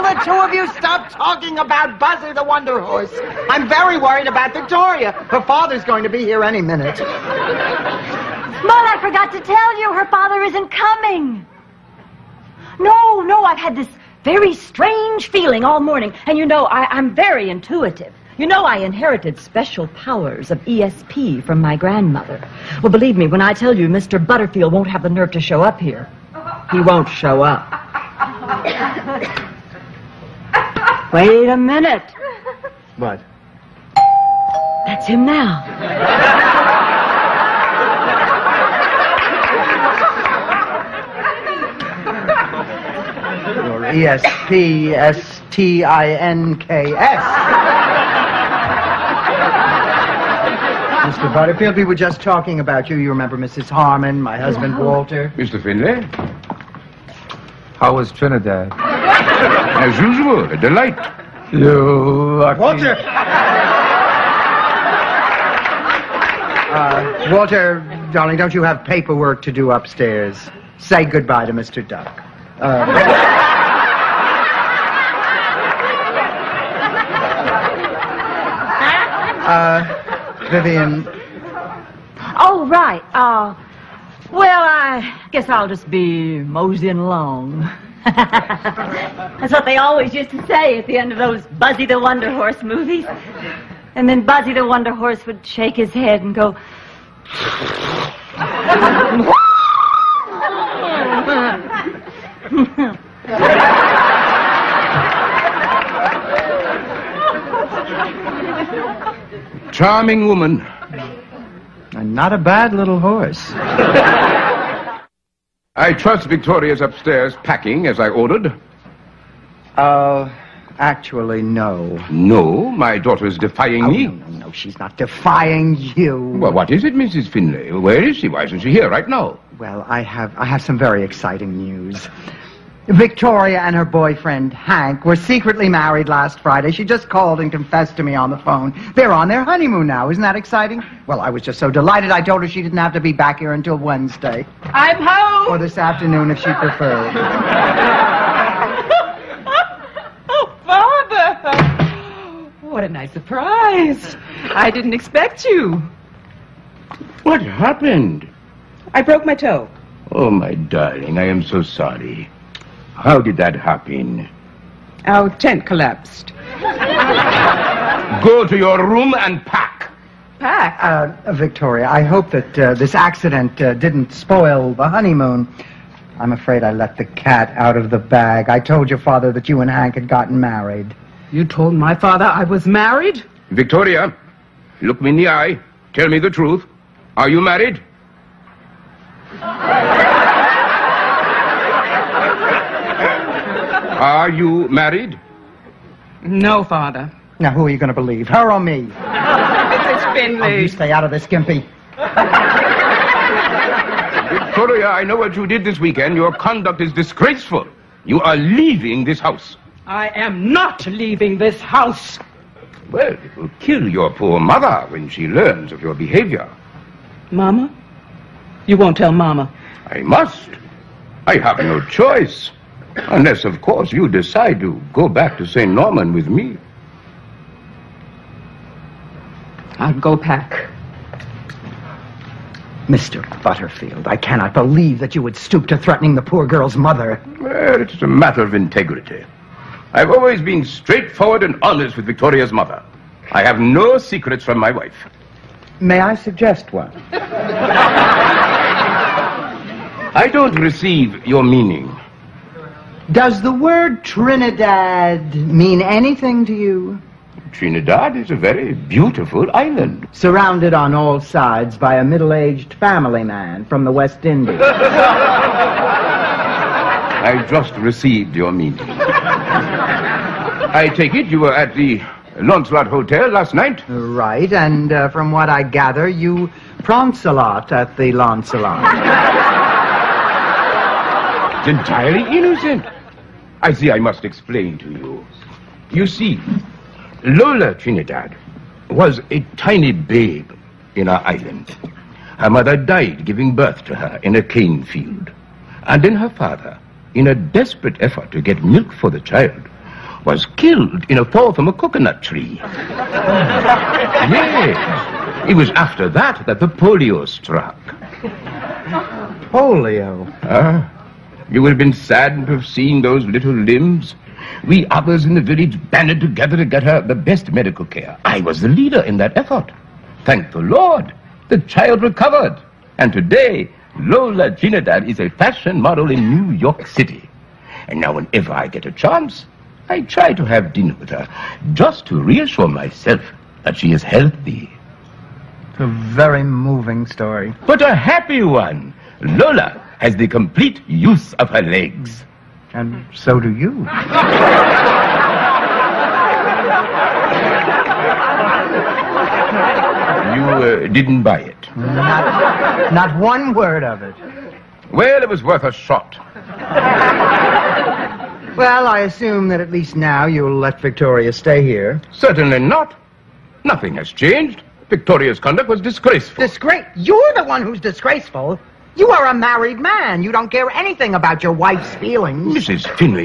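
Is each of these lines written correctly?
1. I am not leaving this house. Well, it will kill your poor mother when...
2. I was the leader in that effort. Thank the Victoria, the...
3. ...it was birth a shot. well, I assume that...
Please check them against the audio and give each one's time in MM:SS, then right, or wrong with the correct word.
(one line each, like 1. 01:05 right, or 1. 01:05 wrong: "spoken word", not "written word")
1. 03:29 right
2. 05:18 wrong: "Lord", not "Victoria"
3. 05:55 wrong: "worth", not "birth".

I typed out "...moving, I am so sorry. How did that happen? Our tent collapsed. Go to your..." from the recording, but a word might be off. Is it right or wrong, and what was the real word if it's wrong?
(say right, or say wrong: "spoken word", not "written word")
wrong: "darling", not "moving".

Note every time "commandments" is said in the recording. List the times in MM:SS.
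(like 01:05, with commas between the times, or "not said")
not said.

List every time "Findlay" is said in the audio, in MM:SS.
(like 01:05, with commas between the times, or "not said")
00:55, 02:07, 03:20.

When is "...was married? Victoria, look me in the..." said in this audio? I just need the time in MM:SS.
03:02.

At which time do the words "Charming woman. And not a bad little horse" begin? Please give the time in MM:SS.
01:49.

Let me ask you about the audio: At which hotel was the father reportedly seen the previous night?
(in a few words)
Launcelot Hotel.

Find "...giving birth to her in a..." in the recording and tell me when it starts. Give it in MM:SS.
04:53.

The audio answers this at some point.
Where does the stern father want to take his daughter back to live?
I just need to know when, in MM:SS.
03:45.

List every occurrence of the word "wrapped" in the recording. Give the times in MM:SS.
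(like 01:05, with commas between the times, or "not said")
not said.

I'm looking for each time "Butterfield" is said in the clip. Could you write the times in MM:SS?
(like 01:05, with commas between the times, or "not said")
00:24, 00:51, 03:53.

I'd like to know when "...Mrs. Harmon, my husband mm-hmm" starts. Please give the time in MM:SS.
00:53.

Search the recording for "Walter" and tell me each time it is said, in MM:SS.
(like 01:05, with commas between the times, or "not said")
00:54, 01:02, 01:07.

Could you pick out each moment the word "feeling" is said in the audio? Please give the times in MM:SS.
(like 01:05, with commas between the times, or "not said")
00:15, 06:11.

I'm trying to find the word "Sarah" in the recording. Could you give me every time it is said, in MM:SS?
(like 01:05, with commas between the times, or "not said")
not said.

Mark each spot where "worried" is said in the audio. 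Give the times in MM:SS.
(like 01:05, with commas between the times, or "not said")
00:03.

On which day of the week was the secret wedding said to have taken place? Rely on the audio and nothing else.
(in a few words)
Friday.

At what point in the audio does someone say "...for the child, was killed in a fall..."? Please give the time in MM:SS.
04:58.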